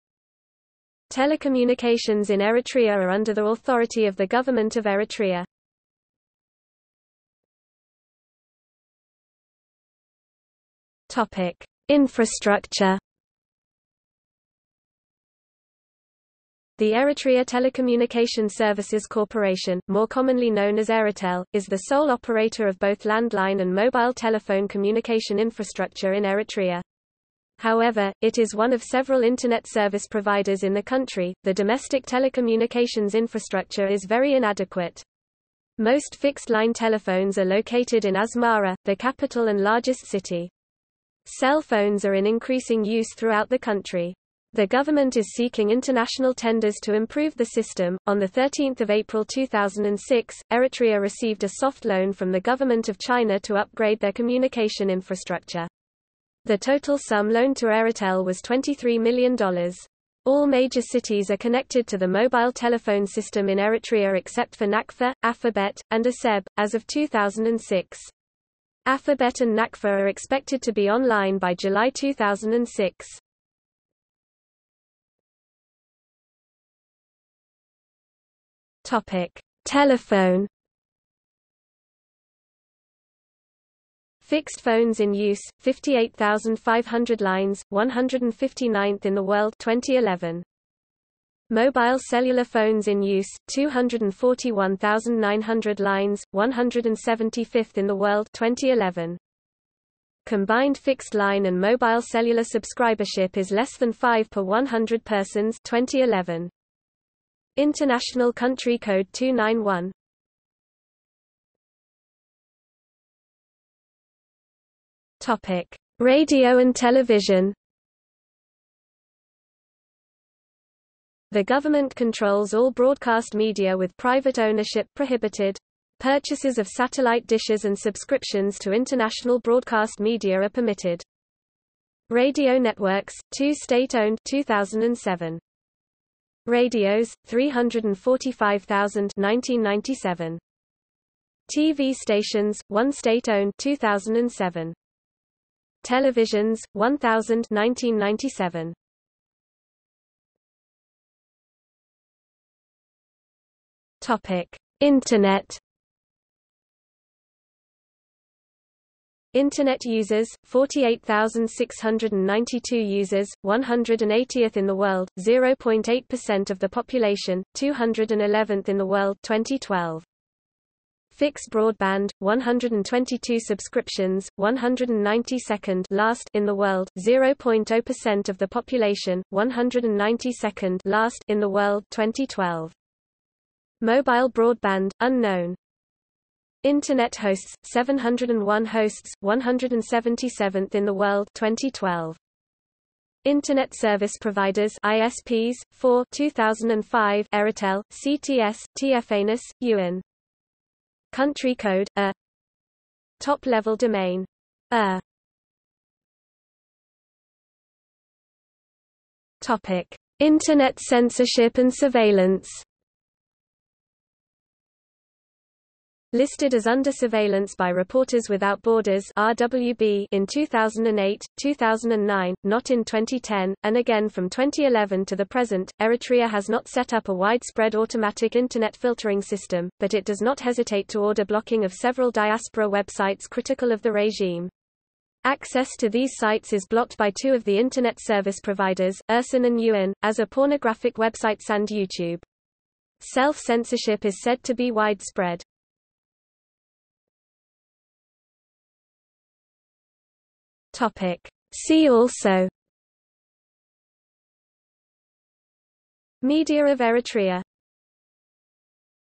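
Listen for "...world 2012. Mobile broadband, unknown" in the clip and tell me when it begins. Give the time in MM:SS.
03:01.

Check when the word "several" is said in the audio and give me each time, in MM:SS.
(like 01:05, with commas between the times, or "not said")
00:28, 03:51.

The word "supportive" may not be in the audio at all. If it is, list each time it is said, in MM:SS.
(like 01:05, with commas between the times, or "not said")
not said.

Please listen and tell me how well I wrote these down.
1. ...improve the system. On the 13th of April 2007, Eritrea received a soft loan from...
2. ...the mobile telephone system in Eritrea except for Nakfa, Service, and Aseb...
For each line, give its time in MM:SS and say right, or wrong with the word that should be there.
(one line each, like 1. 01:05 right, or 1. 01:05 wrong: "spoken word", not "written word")
1. 00:46 wrong: "2006", not "2007"
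2. 01:01 wrong: "Afabet", not "Service".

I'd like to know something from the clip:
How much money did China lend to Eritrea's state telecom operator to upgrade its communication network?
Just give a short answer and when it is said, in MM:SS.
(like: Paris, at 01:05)
$23 million, at 00:58.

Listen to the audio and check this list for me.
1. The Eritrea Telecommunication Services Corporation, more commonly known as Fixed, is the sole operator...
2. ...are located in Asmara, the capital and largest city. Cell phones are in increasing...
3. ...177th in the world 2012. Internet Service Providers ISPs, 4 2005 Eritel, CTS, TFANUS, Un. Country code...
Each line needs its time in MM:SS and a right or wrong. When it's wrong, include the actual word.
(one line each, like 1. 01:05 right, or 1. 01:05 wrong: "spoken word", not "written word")
1. 00:16 wrong: "Eritel", not "Fixed"
2. 00:37 right
3. 03:09 right.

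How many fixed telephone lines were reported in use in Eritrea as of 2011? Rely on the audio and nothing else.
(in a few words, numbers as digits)
58,500.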